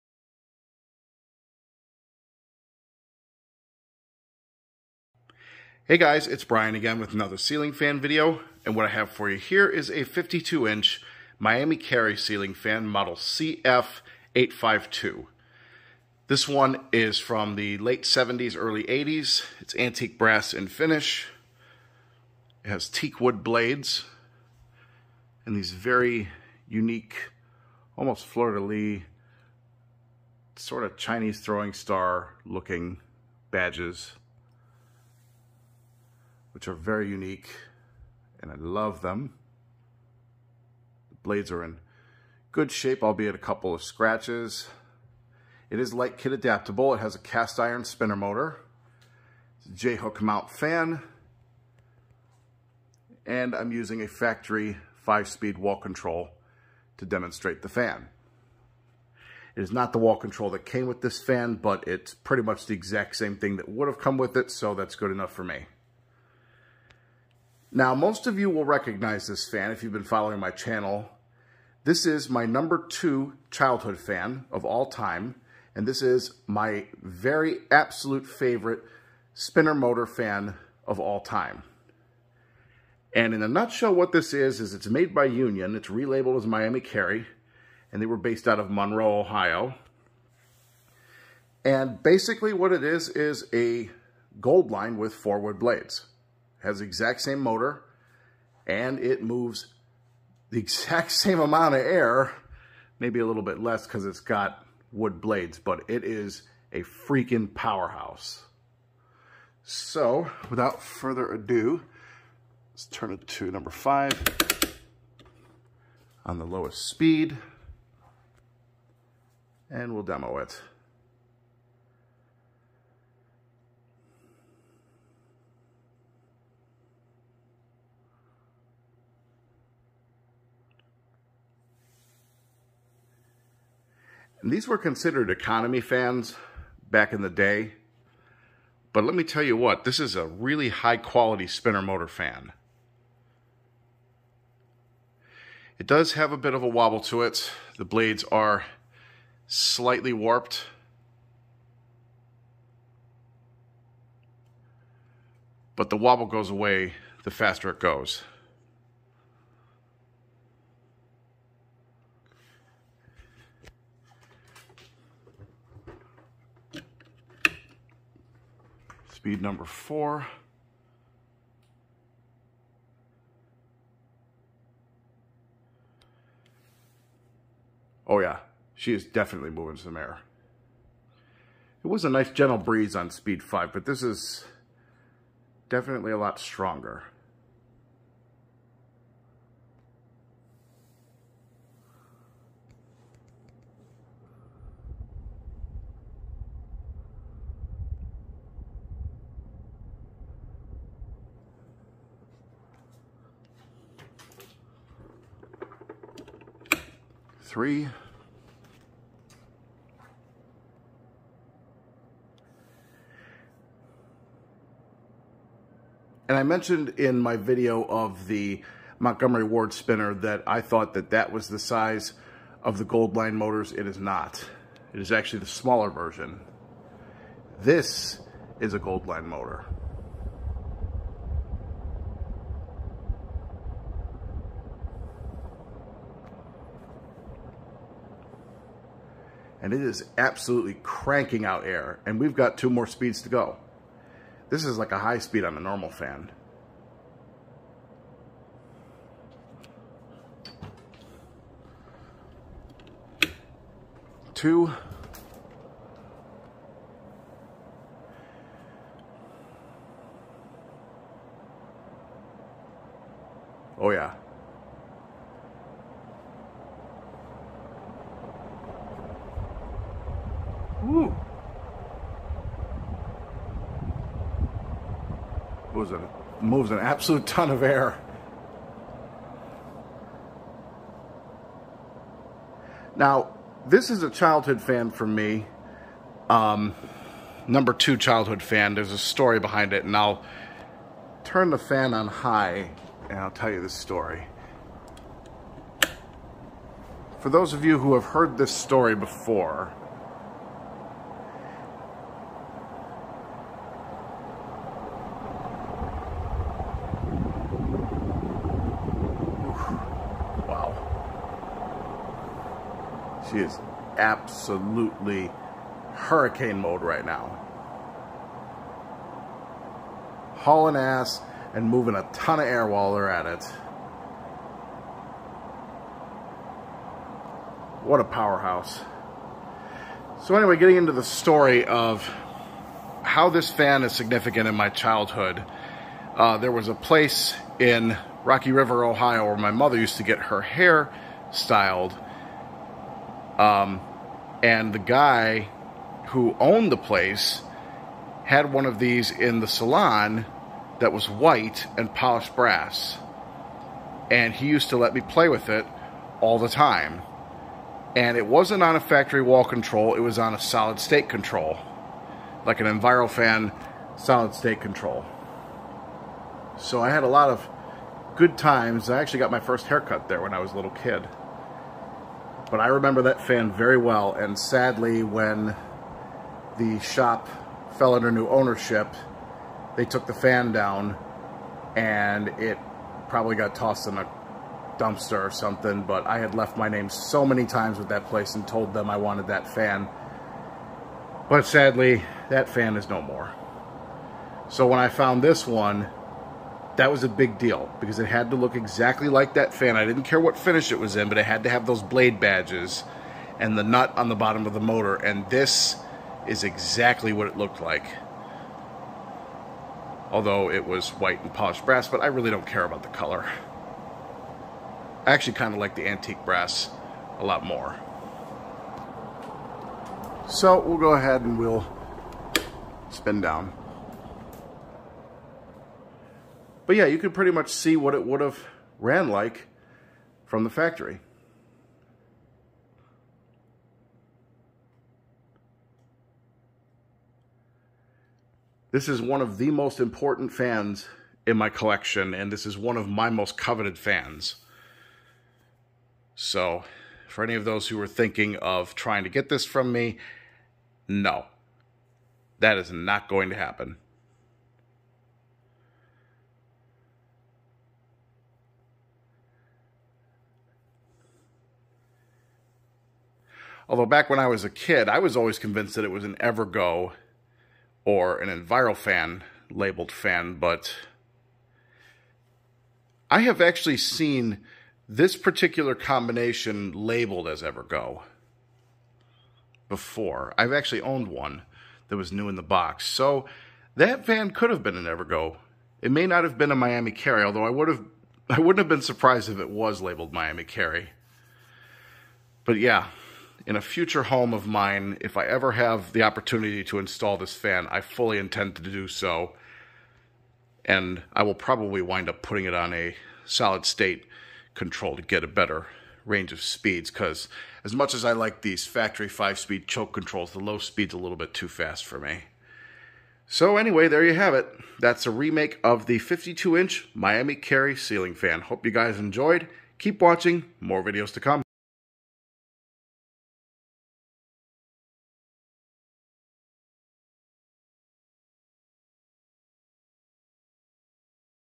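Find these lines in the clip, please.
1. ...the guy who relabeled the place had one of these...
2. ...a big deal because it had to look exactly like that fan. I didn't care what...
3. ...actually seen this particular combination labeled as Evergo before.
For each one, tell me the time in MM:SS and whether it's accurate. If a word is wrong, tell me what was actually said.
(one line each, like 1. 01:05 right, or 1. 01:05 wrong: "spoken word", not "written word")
1. 05:44 wrong: "owned", not "relabeled"
2. 06:37 right
3. 07:53 right.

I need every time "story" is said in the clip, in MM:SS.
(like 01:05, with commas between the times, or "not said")
04:48, 04:53, 04:58, 05:31.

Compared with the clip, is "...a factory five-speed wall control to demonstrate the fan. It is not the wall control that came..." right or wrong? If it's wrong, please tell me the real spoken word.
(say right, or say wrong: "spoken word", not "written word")
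right.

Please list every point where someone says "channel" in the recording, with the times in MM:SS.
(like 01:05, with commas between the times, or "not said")
01:10.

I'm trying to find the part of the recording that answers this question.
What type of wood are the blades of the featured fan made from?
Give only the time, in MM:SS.
00:22.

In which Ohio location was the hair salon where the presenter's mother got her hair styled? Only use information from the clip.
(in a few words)
Rocky River.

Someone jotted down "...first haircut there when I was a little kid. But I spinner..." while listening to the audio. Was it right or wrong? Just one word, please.
wrong.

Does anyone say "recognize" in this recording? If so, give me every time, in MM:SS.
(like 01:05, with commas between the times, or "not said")
01:08.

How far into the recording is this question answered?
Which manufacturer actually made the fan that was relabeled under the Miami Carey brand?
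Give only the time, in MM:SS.
01:25.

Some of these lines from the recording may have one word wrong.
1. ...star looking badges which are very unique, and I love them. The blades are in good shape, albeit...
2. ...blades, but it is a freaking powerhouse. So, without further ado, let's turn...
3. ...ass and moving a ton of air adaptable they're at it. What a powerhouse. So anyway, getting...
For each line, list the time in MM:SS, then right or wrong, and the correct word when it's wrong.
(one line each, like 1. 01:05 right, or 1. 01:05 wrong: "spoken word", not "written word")
1. 00:31 right
2. 01:45 right
3. 05:20 wrong: "while", not "adaptable".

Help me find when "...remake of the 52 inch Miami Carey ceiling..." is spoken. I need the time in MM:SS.
08:35.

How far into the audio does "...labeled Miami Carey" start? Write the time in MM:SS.
08:09.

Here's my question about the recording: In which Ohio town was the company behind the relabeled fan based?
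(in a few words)
Monroe, Ohio.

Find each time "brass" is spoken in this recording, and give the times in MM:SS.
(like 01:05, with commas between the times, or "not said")
00:20, 05:52, 06:51, 06:56.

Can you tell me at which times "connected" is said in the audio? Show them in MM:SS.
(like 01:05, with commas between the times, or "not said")
not said.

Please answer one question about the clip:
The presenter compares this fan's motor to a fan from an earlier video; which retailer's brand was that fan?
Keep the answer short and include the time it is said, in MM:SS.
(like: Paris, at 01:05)
Montgomery Ward, at 03:38.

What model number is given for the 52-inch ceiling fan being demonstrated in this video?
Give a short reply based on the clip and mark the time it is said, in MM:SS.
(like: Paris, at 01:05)
CF852, at 00:13.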